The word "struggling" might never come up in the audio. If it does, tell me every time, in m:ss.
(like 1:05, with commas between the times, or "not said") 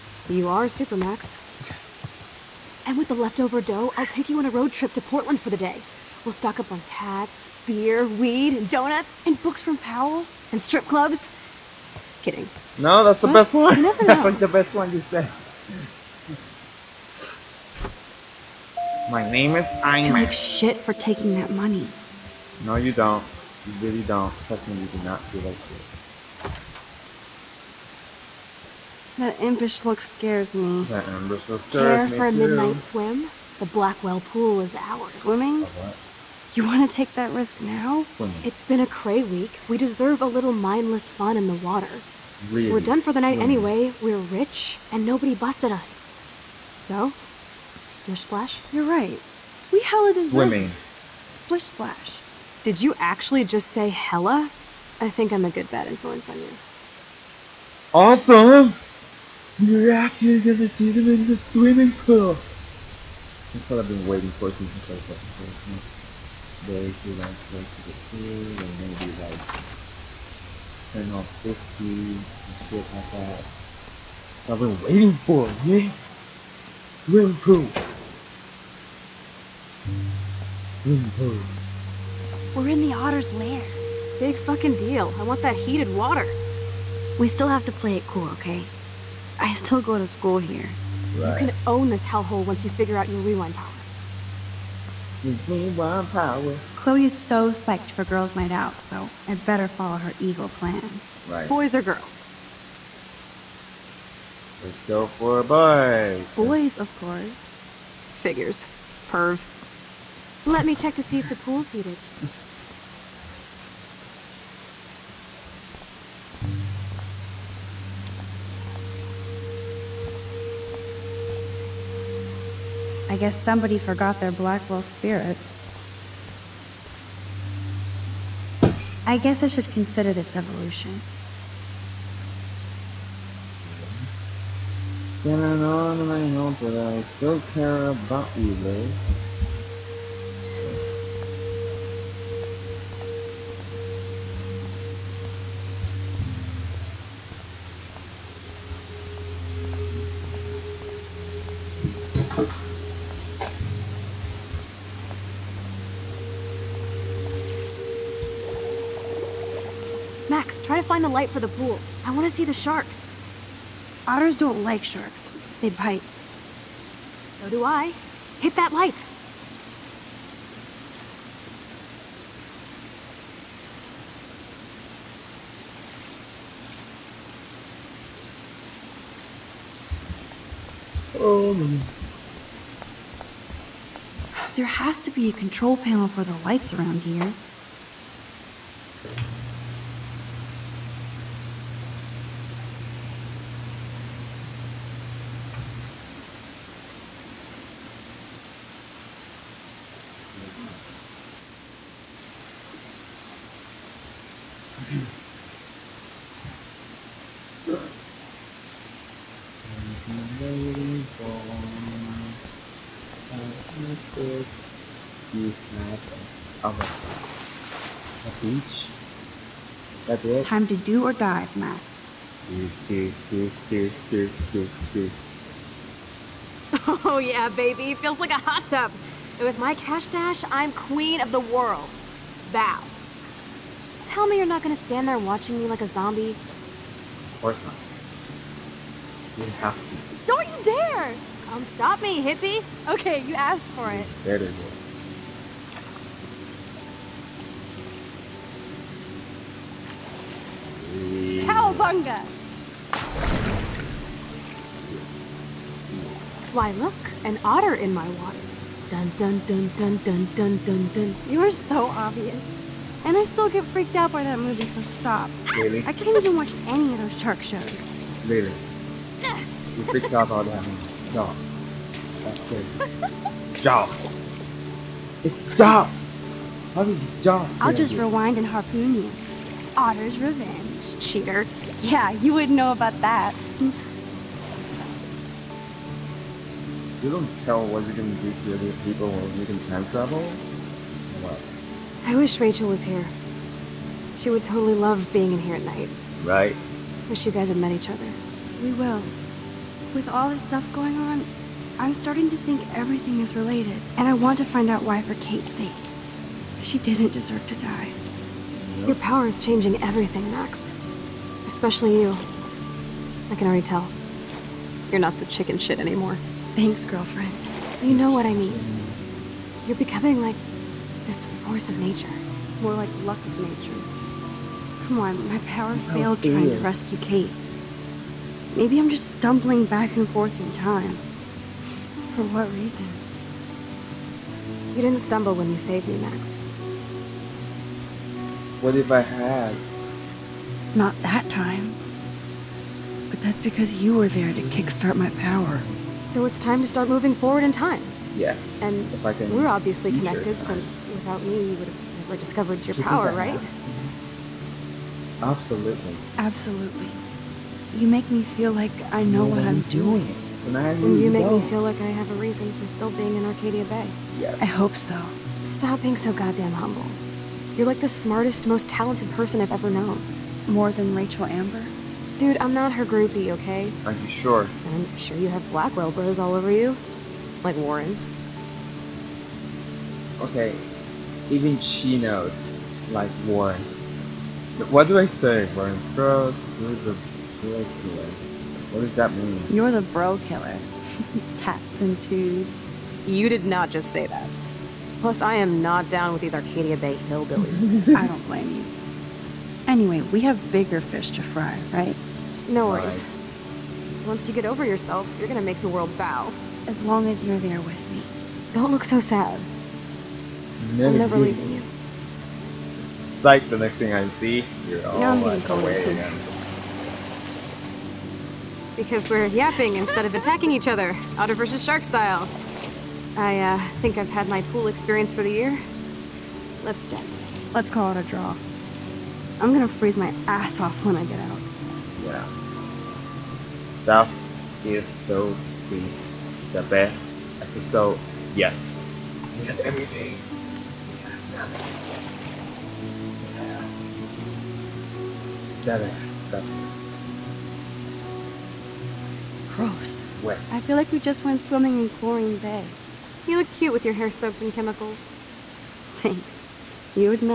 not said.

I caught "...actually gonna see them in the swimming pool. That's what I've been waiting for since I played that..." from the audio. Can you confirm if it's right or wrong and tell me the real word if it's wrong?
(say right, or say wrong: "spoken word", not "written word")
right.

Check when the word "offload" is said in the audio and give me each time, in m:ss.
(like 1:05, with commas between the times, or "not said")
not said.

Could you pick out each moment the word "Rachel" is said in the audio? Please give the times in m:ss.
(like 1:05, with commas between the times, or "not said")
4:52, 6:10.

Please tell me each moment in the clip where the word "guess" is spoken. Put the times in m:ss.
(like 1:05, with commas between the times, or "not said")
2:03, 2:09.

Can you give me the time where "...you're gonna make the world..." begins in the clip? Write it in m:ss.
6:45.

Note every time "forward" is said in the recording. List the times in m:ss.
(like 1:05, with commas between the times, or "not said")
5:47.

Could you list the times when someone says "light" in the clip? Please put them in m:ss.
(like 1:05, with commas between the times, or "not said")
2:41, 2:48, 3:06.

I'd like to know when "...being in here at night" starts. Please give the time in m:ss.
4:55.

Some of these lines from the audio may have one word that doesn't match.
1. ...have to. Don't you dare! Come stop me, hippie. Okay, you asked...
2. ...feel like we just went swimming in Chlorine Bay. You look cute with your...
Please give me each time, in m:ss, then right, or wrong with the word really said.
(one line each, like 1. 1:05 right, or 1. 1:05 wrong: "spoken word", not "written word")
1. 3:59 right
2. 7:30 right.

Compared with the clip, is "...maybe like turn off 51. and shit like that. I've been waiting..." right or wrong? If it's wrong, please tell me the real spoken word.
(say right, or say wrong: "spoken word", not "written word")
wrong: "50", not "51".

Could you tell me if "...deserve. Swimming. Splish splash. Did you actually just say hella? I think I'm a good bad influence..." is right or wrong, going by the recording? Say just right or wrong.
right.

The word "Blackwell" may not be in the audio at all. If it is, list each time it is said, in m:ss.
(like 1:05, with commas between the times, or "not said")
0:33, 2:04, 6:15.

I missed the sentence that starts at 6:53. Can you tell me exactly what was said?
It's like the next thing I see, you're all like away again.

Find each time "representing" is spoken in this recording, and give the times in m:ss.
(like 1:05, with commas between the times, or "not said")
not said.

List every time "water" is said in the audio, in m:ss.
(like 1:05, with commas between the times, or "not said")
0:41, 1:25, 4:18.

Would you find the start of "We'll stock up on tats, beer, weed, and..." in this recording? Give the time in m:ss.
0:06.